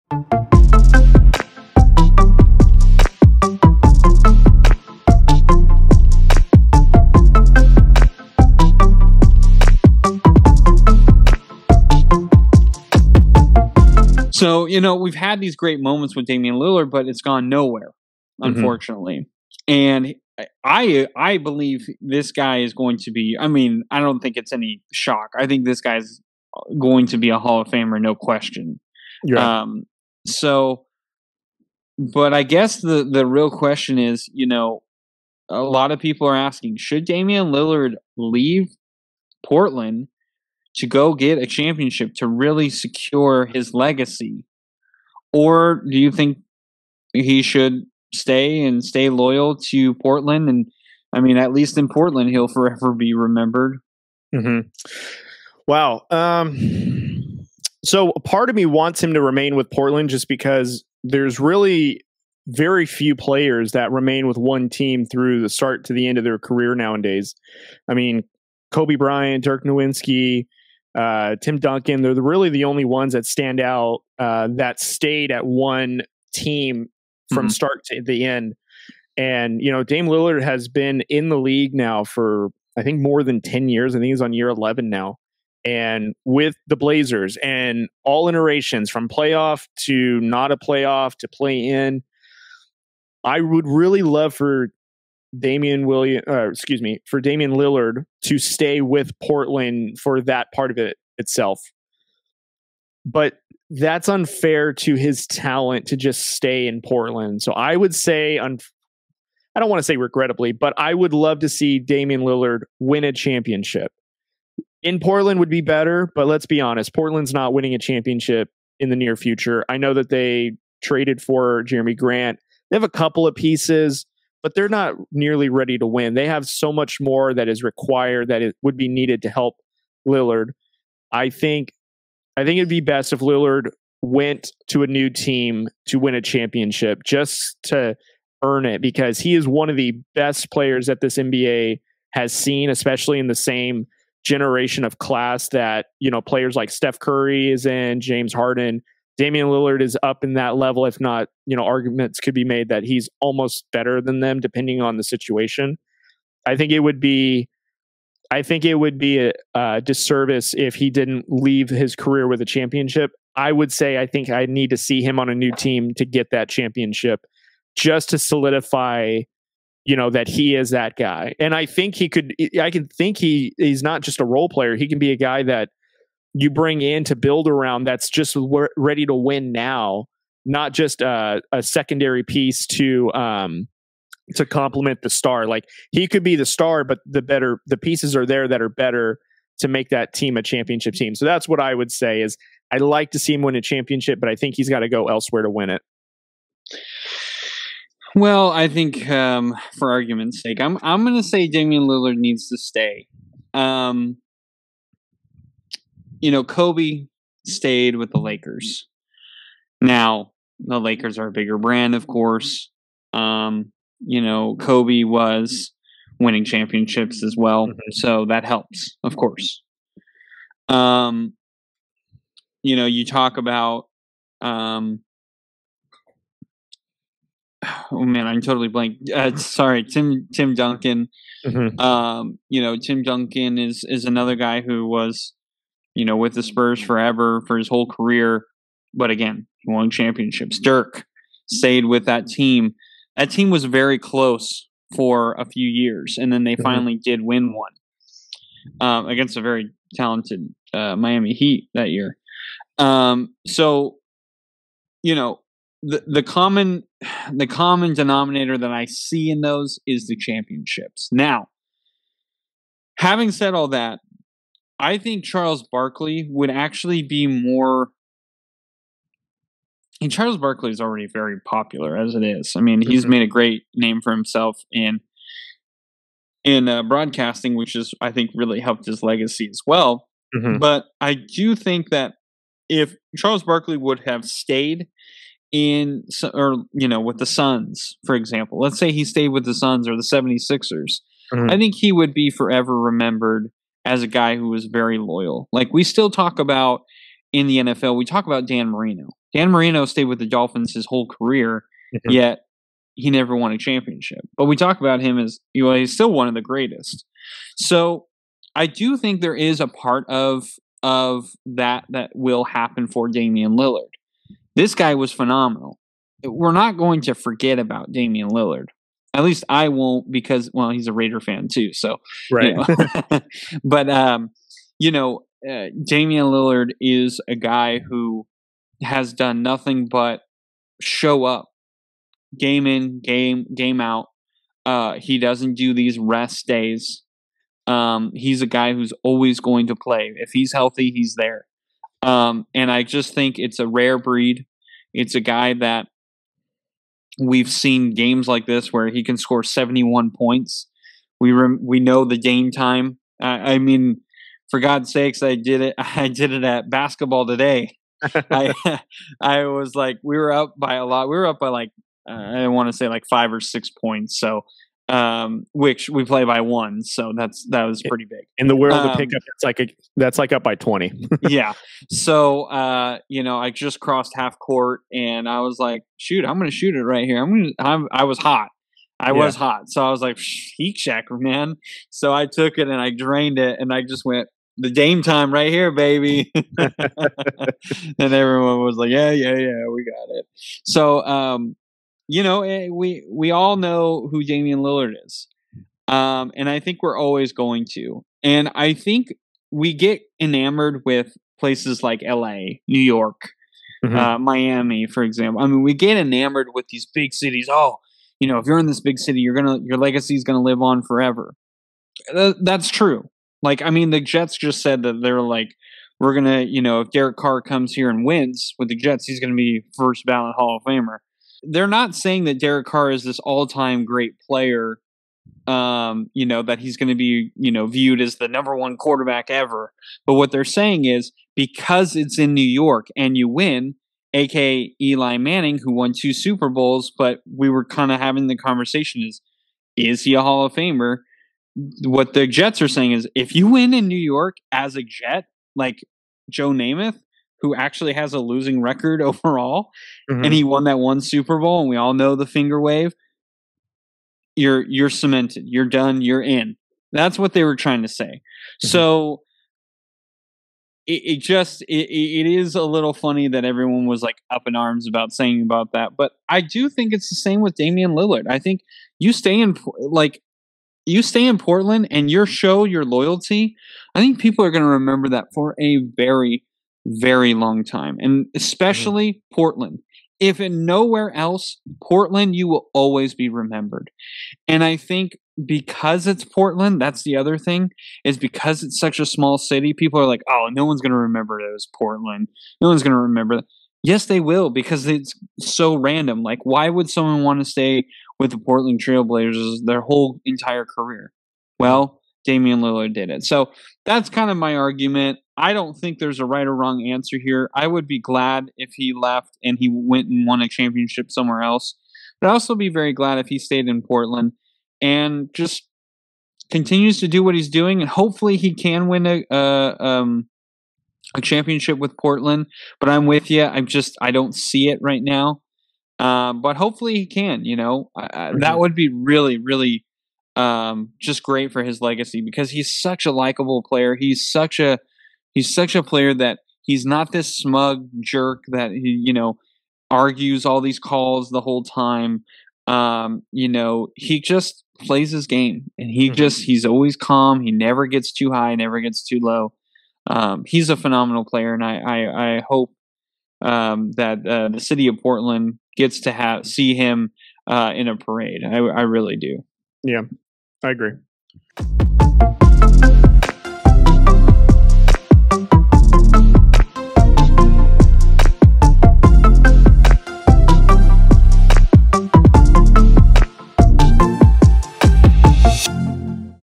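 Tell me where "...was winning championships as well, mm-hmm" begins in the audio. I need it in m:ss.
3:35.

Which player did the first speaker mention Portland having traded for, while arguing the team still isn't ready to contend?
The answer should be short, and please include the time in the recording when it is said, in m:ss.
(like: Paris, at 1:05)
Jerami Grant, at 2:01.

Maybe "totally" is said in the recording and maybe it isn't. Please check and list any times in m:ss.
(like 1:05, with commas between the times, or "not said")
3:48.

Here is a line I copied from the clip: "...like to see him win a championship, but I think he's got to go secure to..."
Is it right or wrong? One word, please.
wrong.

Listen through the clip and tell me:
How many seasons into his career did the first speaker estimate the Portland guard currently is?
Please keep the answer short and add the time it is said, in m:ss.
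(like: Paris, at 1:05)
11, at 1:24.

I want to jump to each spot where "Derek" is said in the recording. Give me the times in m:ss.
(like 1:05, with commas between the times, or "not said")
6:56, 7:02.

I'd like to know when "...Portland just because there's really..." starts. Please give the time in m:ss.
0:59.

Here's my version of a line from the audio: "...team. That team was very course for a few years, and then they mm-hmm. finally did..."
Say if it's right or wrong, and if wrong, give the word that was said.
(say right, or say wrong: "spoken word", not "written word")
wrong: "close", not "course".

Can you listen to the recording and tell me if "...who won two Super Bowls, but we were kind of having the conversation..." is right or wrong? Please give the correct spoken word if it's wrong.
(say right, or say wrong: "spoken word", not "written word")
right.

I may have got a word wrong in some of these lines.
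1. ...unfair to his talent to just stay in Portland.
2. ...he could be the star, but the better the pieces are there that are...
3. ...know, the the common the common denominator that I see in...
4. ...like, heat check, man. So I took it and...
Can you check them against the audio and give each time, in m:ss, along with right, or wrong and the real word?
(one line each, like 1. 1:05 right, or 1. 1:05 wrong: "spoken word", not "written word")
1. 1:44 right
2. 3:05 right
3. 4:15 right
4. 6:20 right.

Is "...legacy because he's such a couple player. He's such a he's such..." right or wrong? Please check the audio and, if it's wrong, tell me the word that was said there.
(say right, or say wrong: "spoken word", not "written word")
wrong: "likable", not "couple".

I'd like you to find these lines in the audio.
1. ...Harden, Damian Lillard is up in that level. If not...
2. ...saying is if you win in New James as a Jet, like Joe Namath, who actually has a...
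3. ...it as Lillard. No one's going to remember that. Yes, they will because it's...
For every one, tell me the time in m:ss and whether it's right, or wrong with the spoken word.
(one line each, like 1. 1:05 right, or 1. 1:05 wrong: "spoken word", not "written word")
1. 2:28 right
2. 7:22 wrong: "York", not "James"
3. 8:11 wrong: "Portland", not "Lillard".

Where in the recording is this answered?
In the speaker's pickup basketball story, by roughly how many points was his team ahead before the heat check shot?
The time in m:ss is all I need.
6:03.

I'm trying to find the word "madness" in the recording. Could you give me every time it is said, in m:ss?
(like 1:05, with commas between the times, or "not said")
not said.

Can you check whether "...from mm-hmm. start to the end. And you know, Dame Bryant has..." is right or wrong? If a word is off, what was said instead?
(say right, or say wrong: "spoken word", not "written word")
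wrong: "Lillard", not "Bryant".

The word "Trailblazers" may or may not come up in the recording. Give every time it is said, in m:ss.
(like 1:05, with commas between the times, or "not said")
8:18.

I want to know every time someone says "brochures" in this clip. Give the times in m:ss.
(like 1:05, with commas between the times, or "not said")
not said.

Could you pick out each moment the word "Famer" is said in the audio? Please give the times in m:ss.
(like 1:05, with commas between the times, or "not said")
0:27, 7:00, 7:20.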